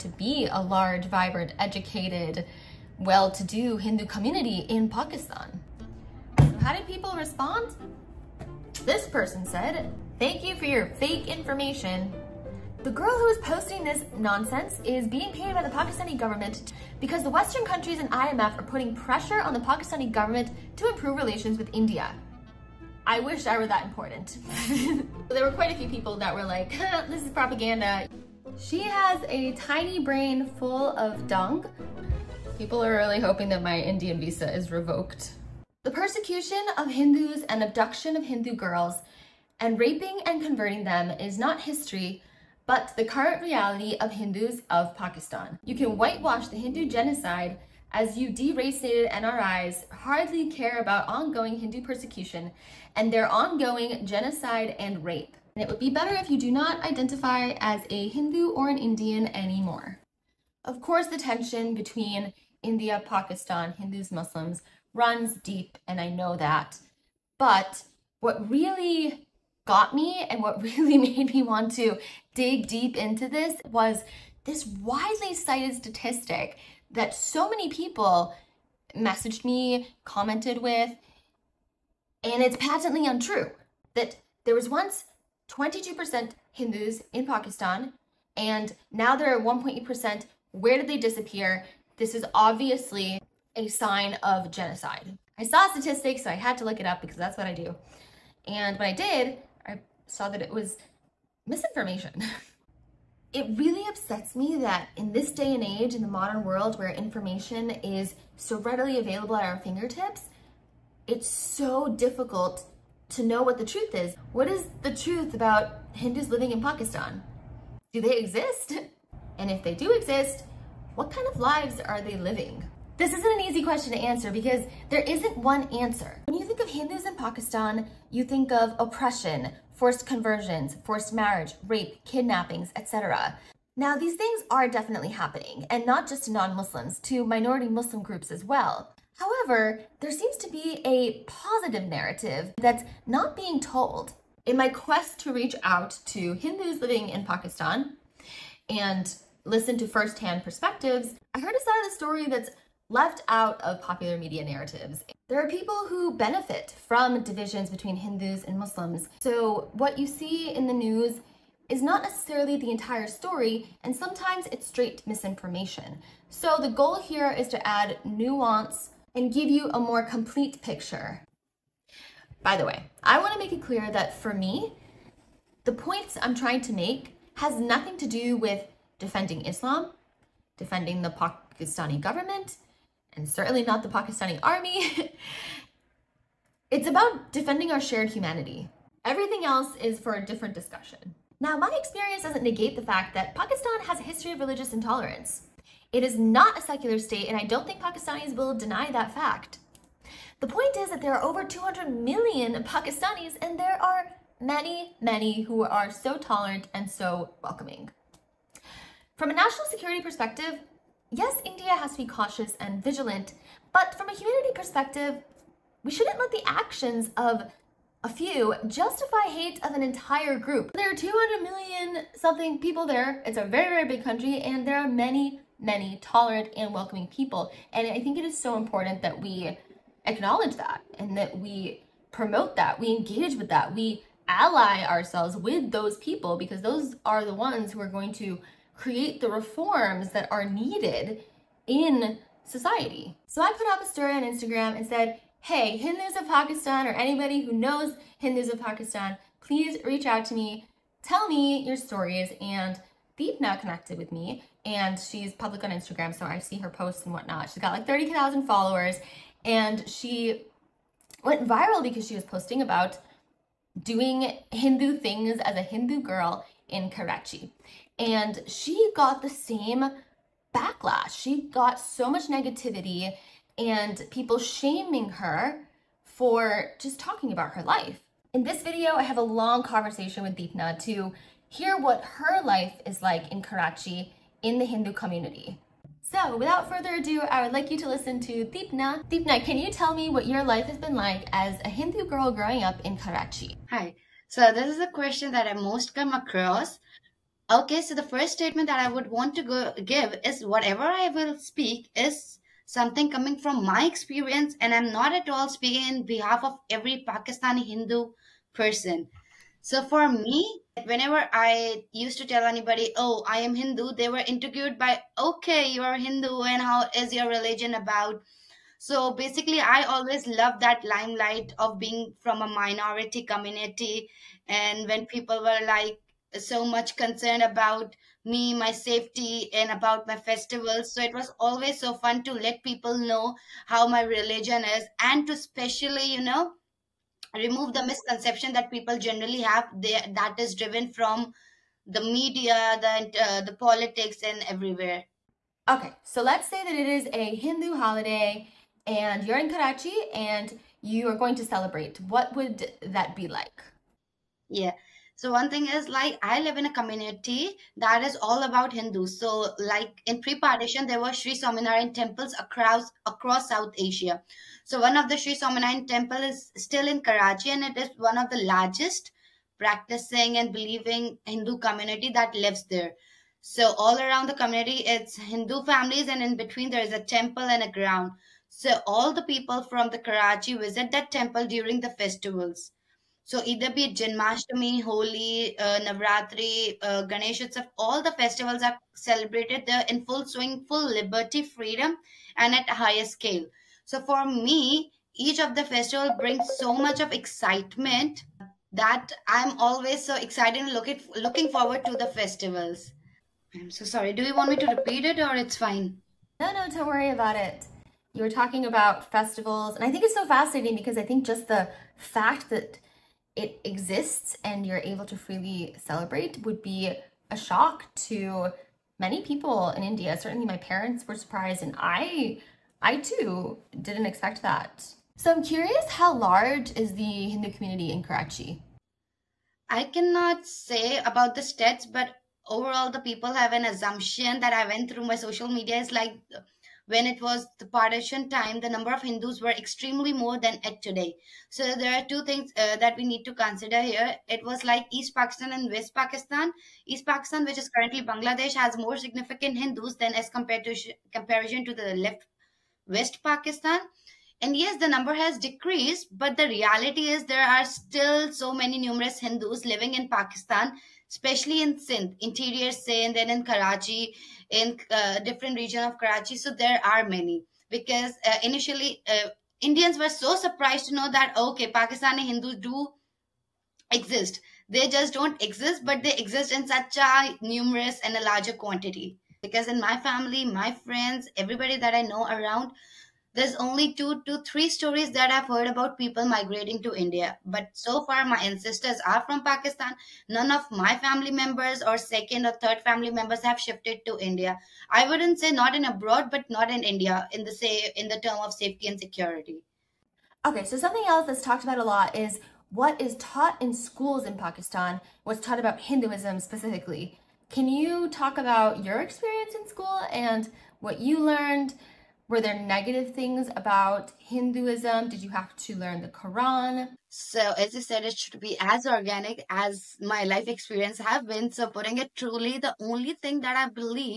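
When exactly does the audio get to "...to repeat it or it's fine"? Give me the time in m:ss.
6:44.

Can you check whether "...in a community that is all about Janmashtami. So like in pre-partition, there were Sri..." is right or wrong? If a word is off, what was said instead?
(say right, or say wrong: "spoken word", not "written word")
wrong: "Hindus", not "Janmashtami".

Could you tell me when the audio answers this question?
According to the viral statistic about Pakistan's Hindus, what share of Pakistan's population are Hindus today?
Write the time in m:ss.
1:29.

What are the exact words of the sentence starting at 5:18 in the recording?
So basically, I always loved that limelight of being from a minority community.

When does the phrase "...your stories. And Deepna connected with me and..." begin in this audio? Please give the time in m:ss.
4:11.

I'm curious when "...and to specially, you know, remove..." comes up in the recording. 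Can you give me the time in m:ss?
5:35.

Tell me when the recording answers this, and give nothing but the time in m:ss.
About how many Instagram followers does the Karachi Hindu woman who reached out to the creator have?
4:17.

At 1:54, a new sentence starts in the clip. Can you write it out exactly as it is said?
What is the truth about Hindus living in Pakistan?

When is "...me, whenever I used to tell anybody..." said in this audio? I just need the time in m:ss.
5:10.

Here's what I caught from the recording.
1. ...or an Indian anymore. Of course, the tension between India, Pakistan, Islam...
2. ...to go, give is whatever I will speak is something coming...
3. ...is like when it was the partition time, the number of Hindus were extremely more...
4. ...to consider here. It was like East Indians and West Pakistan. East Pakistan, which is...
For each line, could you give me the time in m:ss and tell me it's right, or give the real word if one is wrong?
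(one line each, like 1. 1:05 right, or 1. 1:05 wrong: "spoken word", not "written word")
1. 0:58 wrong: "Hindus", not "Islam"
2. 4:59 right
3. 7:15 right
4. 7:23 wrong: "Pakistan", not "Indians".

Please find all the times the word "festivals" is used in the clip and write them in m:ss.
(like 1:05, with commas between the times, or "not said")
5:30, 6:22, 6:28, 6:35, 6:42, 6:49.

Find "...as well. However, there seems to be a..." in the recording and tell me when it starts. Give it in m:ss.
2:18.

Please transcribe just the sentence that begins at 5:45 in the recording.
Okay, so let's say that it is a Hindu holiday and you're in Karachi and you are going to celebrate.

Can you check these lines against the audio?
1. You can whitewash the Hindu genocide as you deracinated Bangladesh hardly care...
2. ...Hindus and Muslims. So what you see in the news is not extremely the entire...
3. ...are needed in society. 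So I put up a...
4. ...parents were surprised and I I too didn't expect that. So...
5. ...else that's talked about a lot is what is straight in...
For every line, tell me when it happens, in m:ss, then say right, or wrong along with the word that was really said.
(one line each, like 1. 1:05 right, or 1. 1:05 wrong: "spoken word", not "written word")
1. 0:45 wrong: "NRIs", not "Bangladesh"
2. 2:37 wrong: "necessarily", not "extremely"
3. 4:00 right
4. 7:00 right
5. 8:21 wrong: "taught", not "straight".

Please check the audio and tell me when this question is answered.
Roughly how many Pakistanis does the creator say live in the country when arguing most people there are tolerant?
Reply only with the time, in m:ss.
3:21.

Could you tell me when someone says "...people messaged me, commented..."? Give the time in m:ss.
1:17.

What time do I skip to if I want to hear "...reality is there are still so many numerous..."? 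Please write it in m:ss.
7:36.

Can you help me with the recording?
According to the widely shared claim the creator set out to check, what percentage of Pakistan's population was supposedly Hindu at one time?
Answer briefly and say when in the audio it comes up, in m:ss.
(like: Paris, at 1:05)
22%, at 1:25.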